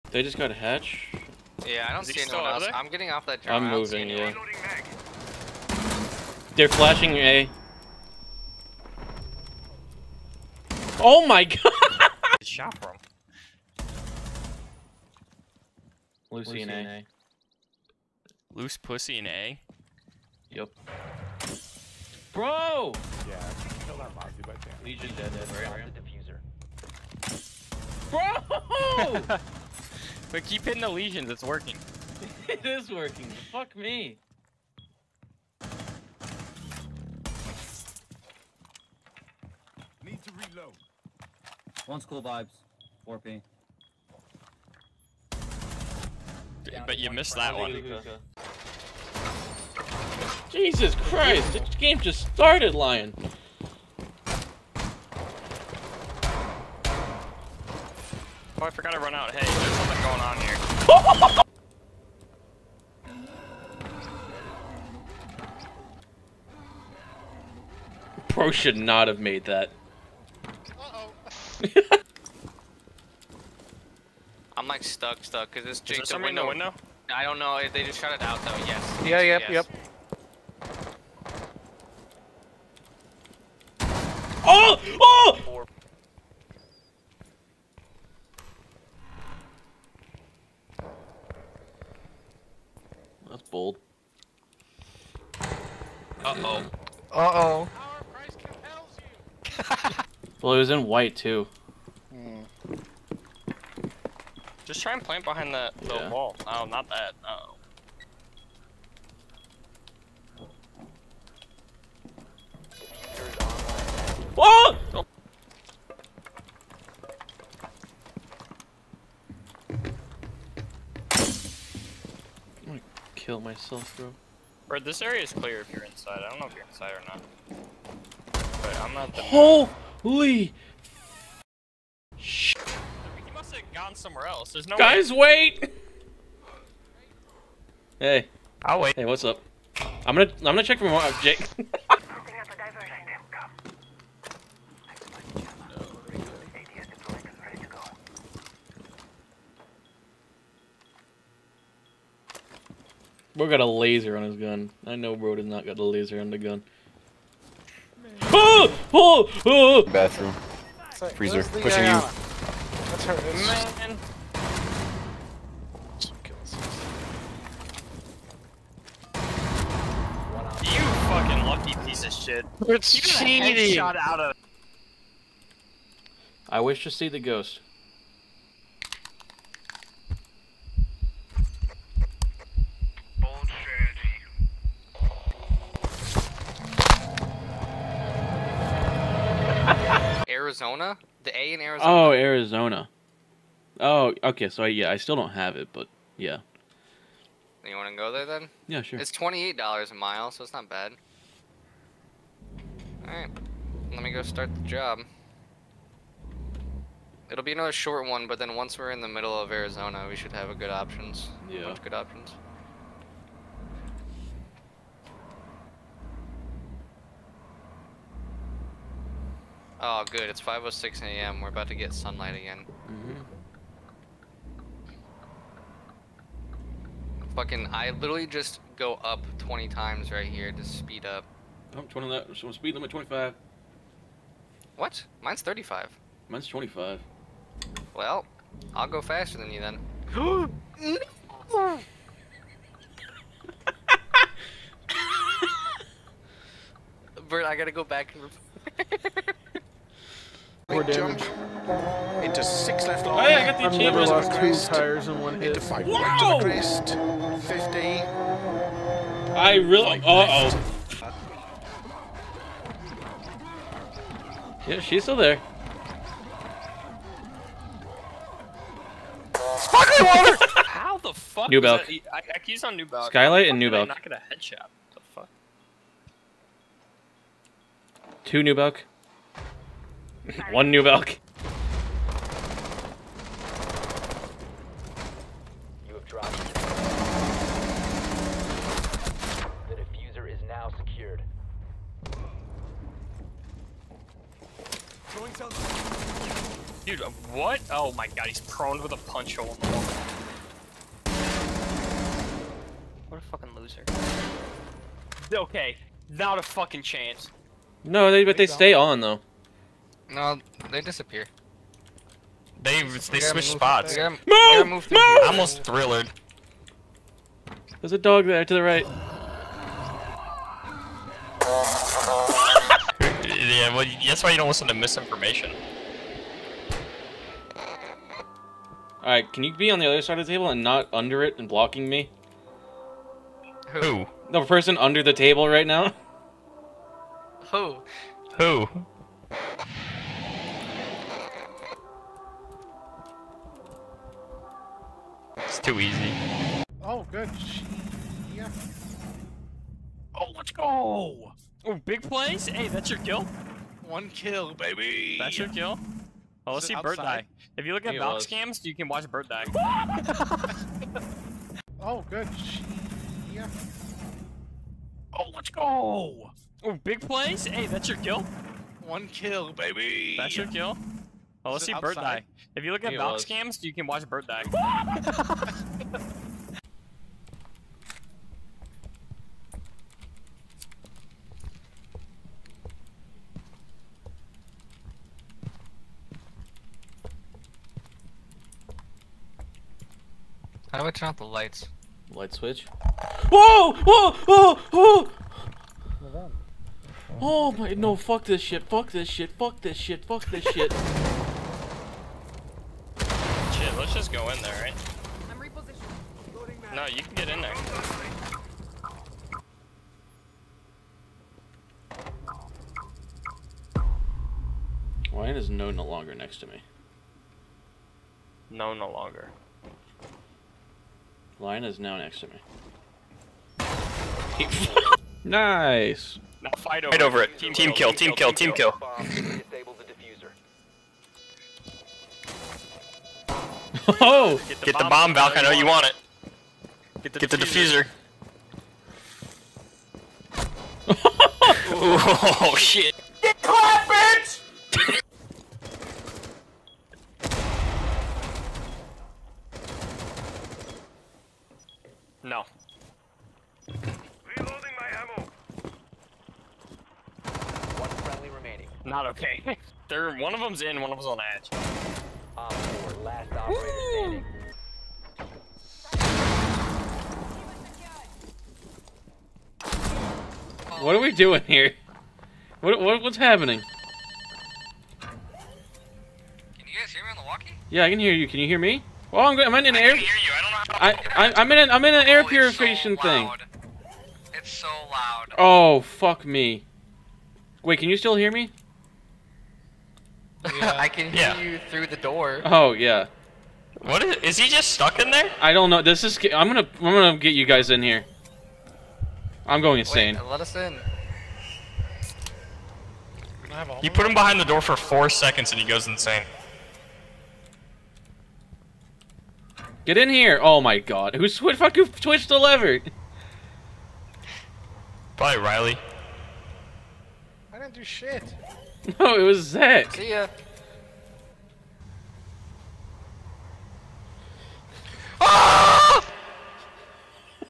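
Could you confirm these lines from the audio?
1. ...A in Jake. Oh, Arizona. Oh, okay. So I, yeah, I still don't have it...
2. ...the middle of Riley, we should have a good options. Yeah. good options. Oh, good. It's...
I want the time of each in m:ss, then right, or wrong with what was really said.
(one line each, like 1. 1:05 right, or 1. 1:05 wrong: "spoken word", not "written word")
1. 3:11 wrong: "Arizona", not "Jake"
2. 3:29 wrong: "Arizona", not "Riley".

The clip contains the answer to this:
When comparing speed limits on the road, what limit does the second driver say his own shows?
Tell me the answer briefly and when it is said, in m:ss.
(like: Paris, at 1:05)
25, at 3:56.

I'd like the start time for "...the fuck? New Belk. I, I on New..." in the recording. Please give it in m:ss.
4:30.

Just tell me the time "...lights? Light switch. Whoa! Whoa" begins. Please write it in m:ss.
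6:31.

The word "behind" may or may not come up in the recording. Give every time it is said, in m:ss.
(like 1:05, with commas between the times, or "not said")
1:45, 8:24.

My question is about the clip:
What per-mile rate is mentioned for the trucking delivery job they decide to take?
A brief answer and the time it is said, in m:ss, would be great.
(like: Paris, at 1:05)
$28 a mile, at 3:19.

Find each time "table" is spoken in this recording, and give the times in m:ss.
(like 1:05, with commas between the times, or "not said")
5:30, 5:35.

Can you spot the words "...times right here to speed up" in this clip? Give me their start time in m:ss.
3:49.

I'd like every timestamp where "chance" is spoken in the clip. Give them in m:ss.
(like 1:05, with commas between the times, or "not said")
0:24, 5:06.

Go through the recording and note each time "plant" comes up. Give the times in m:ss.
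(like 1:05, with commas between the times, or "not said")
1:45.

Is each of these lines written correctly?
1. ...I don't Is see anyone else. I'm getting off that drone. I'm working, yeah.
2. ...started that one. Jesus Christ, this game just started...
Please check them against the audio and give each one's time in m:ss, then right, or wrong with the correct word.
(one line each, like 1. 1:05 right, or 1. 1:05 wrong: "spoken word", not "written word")
1. 0:01 wrong: "moving", not "working"
2. 0:47 wrong: "missed", not "started".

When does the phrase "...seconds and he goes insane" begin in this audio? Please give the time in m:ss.
8:25.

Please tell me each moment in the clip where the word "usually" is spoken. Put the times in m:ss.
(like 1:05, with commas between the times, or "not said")
not said.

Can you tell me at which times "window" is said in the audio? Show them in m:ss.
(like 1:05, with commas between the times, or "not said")
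1:16.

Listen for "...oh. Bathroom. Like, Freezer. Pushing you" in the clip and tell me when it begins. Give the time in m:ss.
2:39.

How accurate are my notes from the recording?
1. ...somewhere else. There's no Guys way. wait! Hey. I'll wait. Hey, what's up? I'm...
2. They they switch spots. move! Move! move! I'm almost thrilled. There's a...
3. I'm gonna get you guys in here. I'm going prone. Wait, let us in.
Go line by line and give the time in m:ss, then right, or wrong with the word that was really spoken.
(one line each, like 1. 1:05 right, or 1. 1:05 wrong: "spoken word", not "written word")
1. 2:13 right
2. 5:12 right
3. 8:16 wrong: "insane", not "prone".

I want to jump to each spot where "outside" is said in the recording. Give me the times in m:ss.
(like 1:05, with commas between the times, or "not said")
5:56, 6:11.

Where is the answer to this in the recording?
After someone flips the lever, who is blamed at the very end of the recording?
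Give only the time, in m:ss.
8:39.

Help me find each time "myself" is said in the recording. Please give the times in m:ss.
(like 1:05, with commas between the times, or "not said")
2:03.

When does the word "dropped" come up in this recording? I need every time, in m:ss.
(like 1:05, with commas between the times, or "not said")
4:46.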